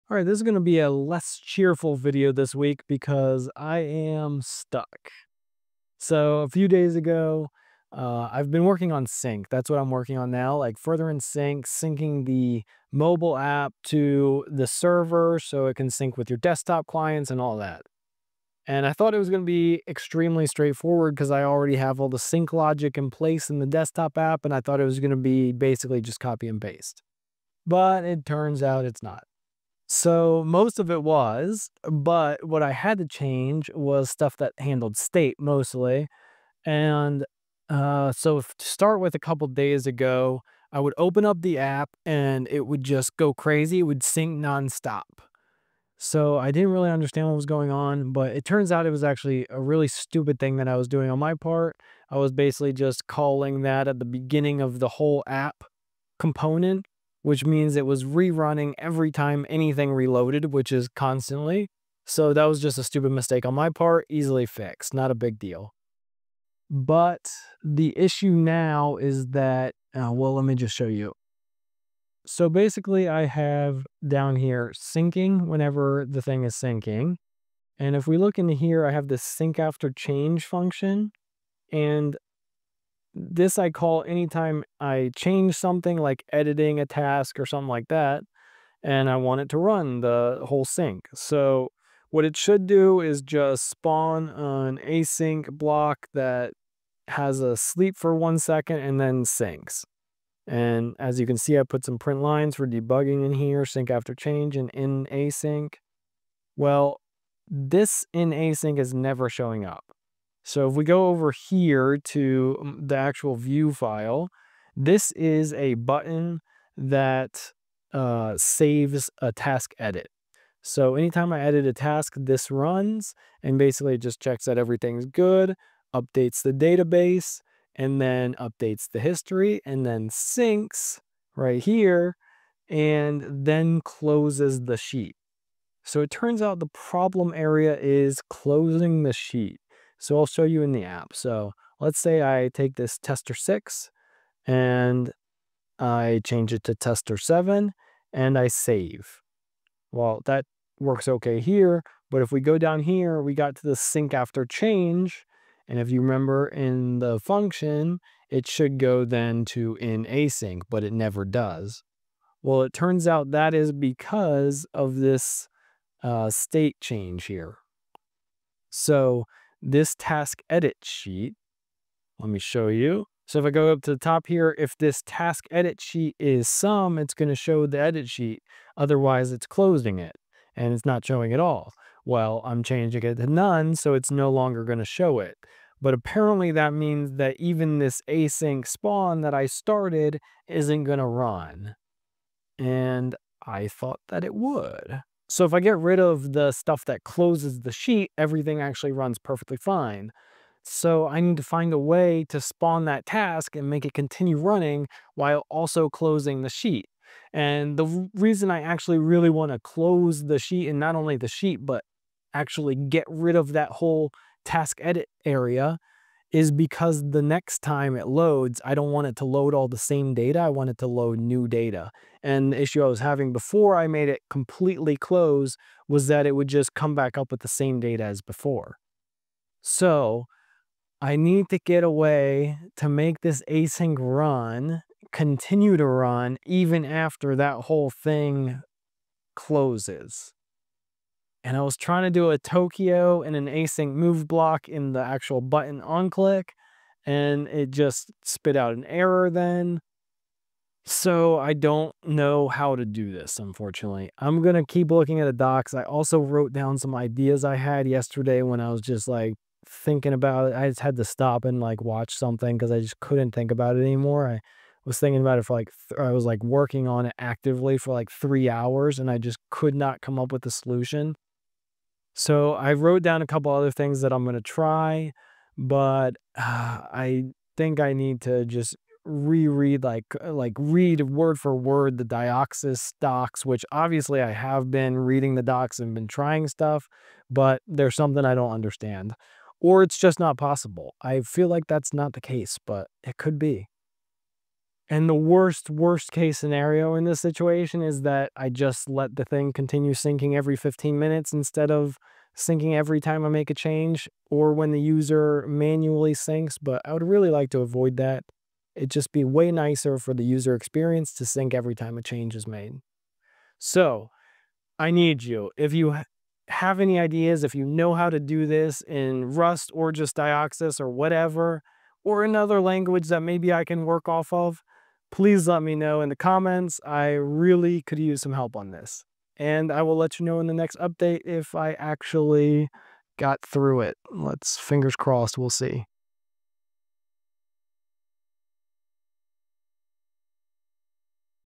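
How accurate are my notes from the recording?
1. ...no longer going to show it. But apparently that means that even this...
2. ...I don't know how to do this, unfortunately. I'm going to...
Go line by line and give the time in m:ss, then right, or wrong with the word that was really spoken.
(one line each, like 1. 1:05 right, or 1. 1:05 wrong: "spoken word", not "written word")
1. 3:04 right
2. 4:11 right.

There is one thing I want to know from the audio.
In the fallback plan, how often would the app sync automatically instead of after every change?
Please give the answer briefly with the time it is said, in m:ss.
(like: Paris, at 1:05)
every 15 minutes, at 5:00.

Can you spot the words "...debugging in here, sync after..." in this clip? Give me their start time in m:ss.
1:42.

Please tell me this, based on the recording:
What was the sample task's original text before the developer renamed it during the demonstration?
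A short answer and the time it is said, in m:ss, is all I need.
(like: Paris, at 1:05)
tester six, at 2:22.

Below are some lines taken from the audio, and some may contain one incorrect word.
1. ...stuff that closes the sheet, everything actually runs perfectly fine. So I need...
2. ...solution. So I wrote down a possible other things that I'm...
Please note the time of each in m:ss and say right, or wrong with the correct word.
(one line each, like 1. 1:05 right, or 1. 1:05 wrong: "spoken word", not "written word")
1. 3:16 right
2. 4:30 wrong: "couple", not "possible".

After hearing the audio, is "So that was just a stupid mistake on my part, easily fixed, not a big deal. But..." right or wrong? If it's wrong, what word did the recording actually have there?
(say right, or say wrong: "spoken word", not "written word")
right.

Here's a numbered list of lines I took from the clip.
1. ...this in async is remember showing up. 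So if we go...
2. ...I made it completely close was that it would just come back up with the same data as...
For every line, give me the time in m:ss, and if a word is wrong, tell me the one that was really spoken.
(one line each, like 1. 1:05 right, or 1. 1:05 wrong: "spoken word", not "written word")
1. 1:47 wrong: "never", not "remember"
2. 3:43 right.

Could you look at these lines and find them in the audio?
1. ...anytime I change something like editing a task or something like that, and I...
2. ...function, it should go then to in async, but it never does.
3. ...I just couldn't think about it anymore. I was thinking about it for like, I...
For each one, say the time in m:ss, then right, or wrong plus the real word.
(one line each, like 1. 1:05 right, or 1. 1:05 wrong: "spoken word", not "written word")
1. 1:24 right
2. 2:37 right
3. 4:22 right.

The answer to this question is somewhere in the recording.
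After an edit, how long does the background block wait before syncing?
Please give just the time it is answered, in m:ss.
1:38.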